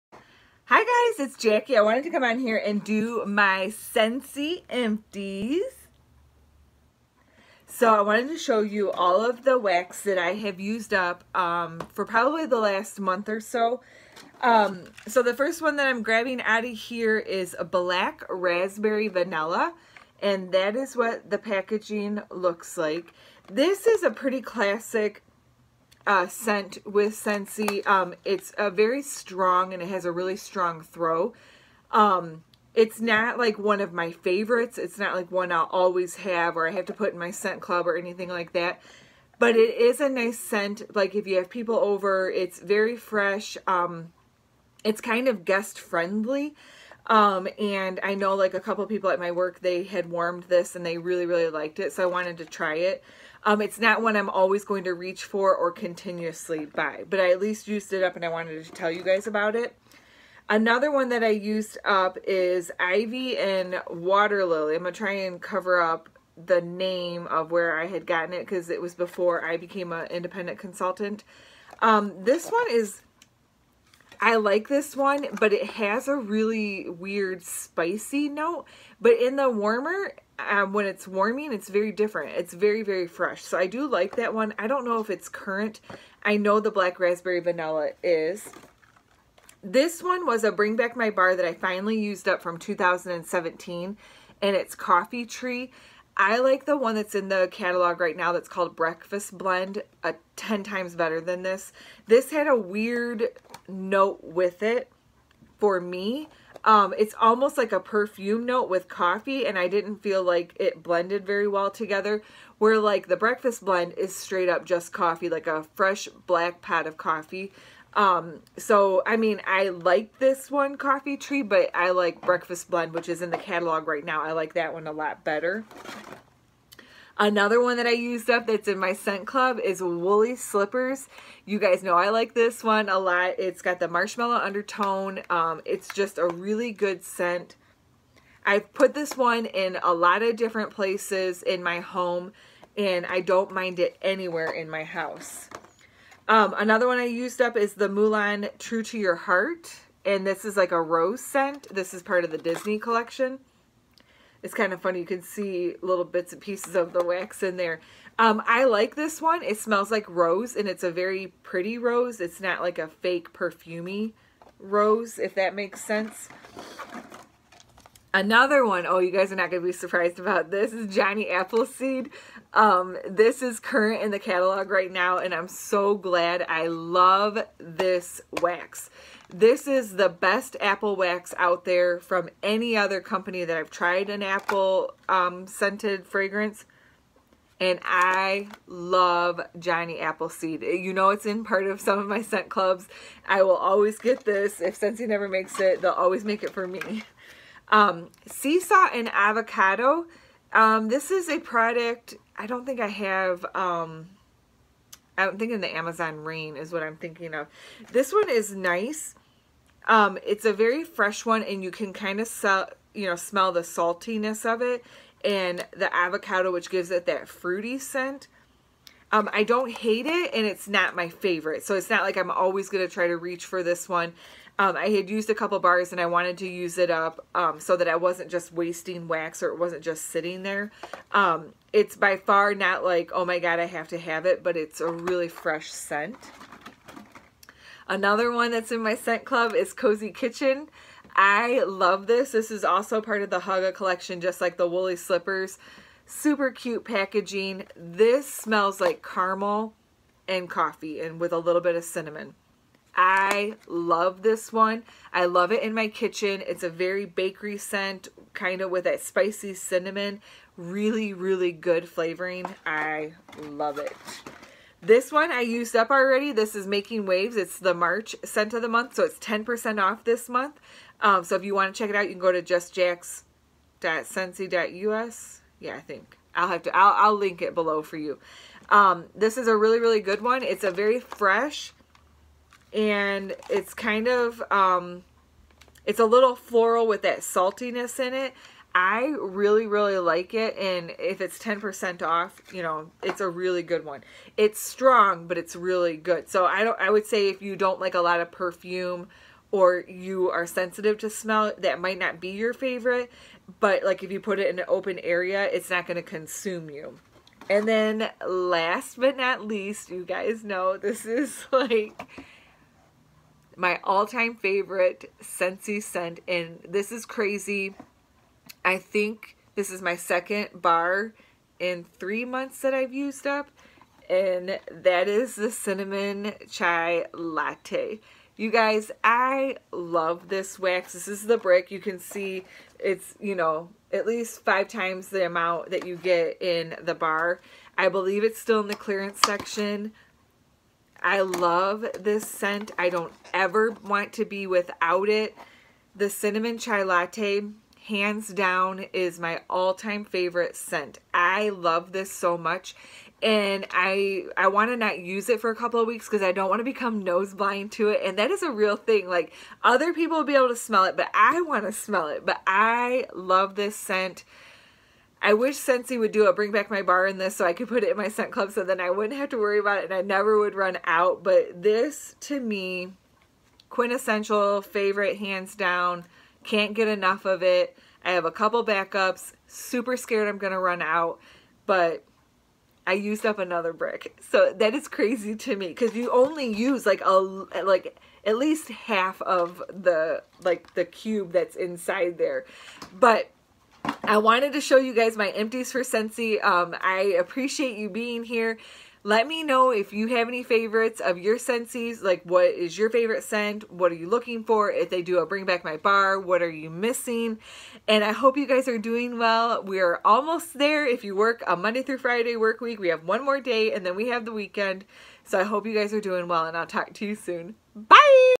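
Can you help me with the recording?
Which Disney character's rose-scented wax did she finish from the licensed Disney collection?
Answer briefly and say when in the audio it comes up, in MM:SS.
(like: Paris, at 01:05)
Mulan, at 02:27.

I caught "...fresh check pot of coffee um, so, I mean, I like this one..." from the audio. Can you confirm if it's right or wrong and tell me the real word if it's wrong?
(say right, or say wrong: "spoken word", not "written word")
wrong: "black", not "check".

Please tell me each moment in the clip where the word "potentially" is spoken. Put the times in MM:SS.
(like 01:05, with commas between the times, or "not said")
not said.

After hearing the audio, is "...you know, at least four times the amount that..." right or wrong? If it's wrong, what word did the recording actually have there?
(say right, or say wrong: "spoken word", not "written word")
wrong: "five", not "four".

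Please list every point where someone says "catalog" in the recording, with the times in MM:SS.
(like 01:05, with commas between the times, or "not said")
01:37, 02:03, 02:54.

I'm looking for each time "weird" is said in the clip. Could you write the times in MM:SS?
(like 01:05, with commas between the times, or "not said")
01:16, 01:42.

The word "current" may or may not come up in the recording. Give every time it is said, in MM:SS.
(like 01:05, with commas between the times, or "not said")
01:25, 02:53.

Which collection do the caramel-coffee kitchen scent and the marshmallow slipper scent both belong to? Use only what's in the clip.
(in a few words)
Hygge.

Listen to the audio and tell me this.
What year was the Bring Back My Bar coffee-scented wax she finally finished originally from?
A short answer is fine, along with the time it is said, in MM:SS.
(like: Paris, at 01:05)
2017, at 01:32.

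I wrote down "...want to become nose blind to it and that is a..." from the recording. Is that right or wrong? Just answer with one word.
right.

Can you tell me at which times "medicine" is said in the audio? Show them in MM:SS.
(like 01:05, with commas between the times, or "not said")
not said.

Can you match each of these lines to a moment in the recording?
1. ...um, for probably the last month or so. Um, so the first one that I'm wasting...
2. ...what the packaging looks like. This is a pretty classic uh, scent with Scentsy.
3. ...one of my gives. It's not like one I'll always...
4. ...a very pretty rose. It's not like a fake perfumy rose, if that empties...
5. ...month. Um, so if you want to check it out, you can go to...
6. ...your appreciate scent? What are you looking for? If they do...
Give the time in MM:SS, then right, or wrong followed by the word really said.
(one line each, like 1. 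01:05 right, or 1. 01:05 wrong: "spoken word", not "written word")
1. 00:11 wrong: "grabbing", not "wasting"
2. 00:20 right
3. 00:33 wrong: "favorites", not "gives"
4. 02:40 wrong: "makes", not "empties"
5. 04:30 right
6. 06:42 wrong: "favorite", not "appreciate".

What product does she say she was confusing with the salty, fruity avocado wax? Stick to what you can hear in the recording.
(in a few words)
Amazon Rain.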